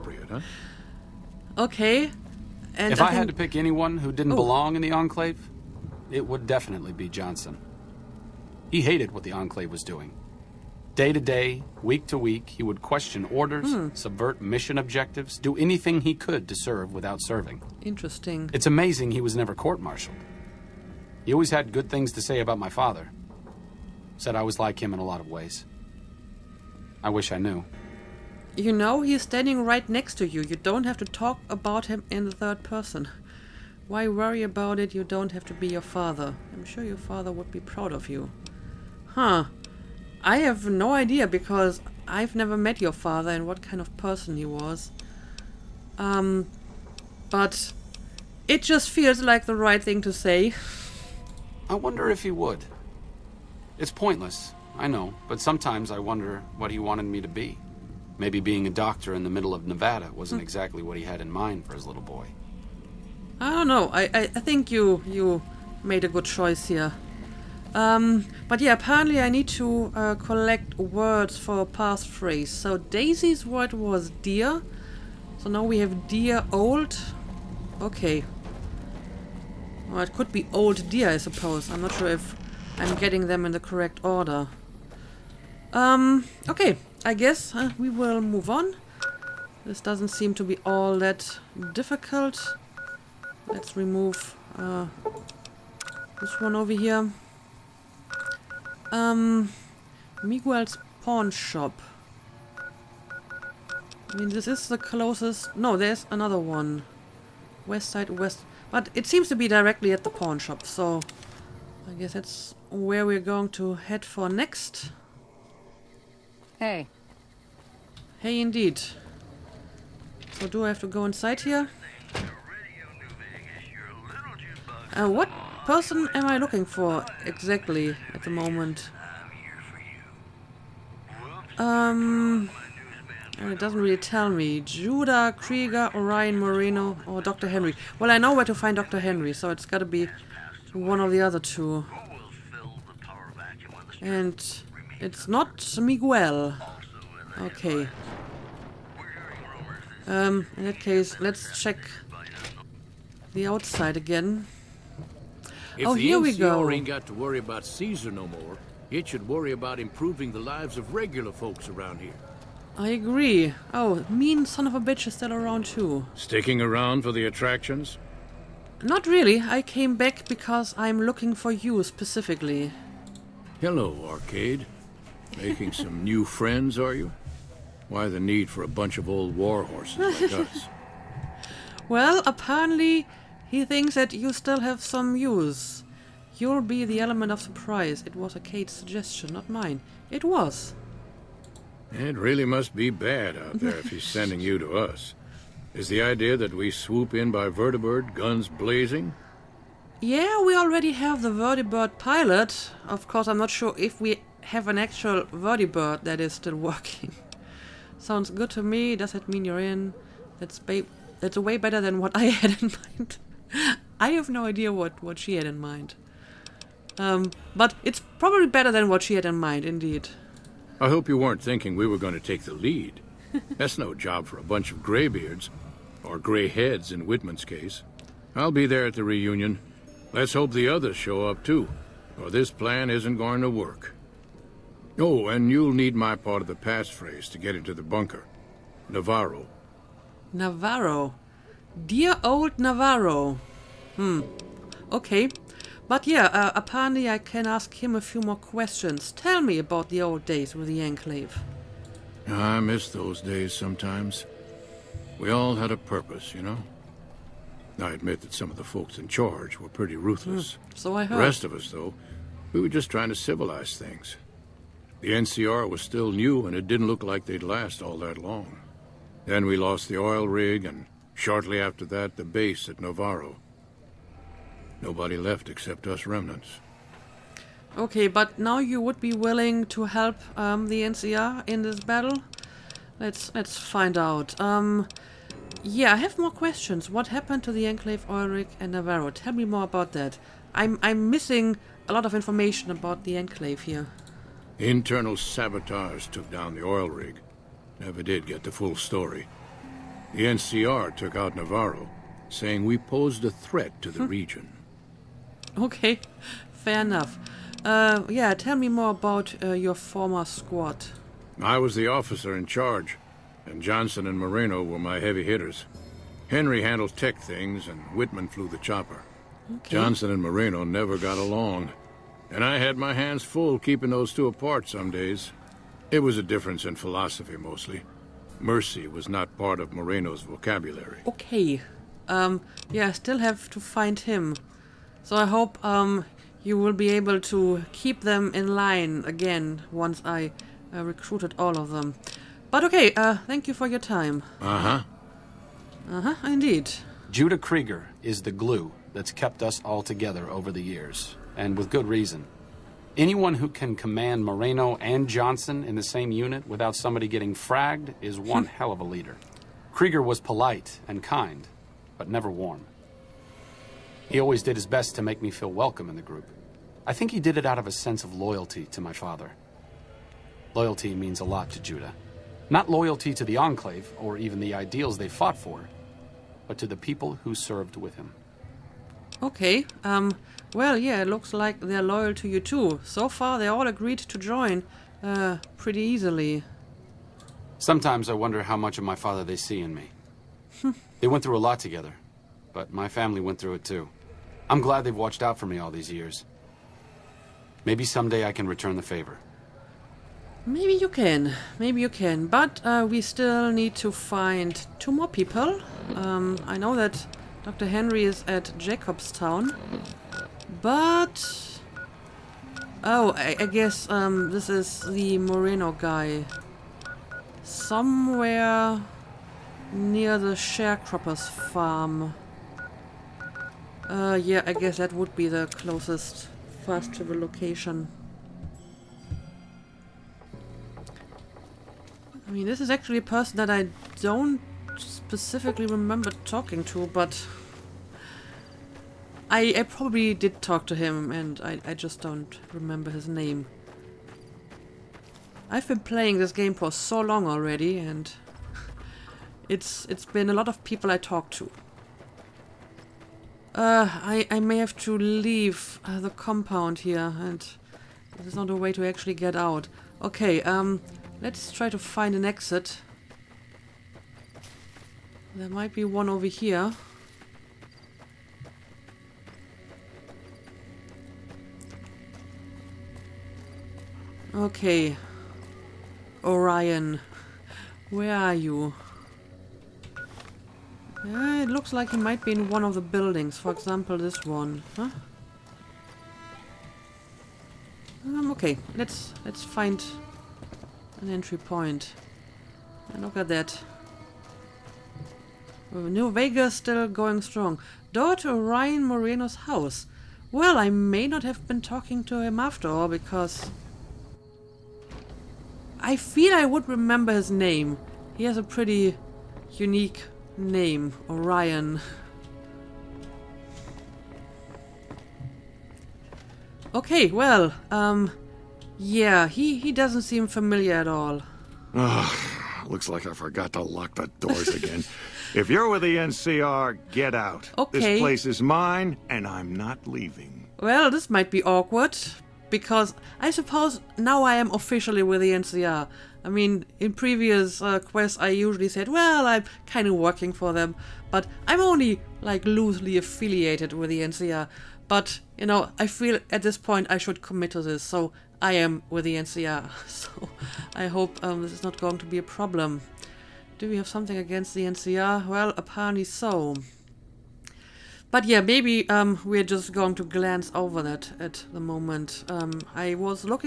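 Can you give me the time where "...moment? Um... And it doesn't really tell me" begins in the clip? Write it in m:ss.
2:08.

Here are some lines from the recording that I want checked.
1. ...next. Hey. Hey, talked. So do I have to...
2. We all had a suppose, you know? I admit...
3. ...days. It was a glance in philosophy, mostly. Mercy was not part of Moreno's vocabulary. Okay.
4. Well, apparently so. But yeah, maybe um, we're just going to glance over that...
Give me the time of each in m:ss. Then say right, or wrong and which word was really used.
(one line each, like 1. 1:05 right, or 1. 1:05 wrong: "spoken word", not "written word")
1. 1:54 wrong: "indeed", not "talked"
2. 4:15 wrong: "purpose", not "suppose"
3. 5:24 wrong: "difference", not "glance"
4. 9:15 right.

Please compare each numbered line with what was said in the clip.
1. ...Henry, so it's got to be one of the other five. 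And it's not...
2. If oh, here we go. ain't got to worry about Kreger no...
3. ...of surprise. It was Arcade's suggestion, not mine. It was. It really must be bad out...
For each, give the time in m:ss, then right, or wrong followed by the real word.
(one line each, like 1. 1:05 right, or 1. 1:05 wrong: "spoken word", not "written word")
1. 2:18 wrong: "two", not "five"
2. 2:35 wrong: "Caesar", not "Kreger"
3. 3:07 right.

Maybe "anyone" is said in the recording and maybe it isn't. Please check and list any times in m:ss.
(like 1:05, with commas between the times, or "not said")
0:03, 5:52.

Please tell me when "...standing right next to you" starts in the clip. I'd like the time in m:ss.
0:29.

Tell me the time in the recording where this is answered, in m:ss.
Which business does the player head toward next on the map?
1:40.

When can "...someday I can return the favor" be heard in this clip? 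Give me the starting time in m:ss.
6:37.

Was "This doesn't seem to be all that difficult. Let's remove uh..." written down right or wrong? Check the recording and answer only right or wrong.
right.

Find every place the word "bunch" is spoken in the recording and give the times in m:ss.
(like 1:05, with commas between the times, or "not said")
2:58, 3:44.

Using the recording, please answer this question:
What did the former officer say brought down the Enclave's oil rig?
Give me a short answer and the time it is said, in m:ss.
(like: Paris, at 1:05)
Internal sabotage, at 4:54.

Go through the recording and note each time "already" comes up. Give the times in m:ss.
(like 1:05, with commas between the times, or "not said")
3:20, 7:27.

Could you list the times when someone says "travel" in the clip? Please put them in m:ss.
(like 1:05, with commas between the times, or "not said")
7:06.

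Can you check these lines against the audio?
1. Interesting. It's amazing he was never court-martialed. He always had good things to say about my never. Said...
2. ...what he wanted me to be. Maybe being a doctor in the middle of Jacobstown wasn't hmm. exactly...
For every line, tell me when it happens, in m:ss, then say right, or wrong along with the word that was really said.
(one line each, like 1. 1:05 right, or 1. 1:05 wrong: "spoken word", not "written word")
1. 0:17 wrong: "father", not "never"
2. 0:56 wrong: "Nevada", not "Jacobstown".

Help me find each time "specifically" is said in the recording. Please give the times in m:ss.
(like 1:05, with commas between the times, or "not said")
2:51, 7:14.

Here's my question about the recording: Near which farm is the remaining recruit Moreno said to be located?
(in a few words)
the sharecropper's farm.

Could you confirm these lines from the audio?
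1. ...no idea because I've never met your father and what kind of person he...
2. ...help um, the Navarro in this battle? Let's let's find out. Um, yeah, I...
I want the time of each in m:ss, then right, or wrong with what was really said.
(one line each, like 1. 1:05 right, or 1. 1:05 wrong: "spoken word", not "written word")
1. 0:40 right
2. 4:39 wrong: "NCR", not "Navarro".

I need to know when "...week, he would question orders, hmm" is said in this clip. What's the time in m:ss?
0:12.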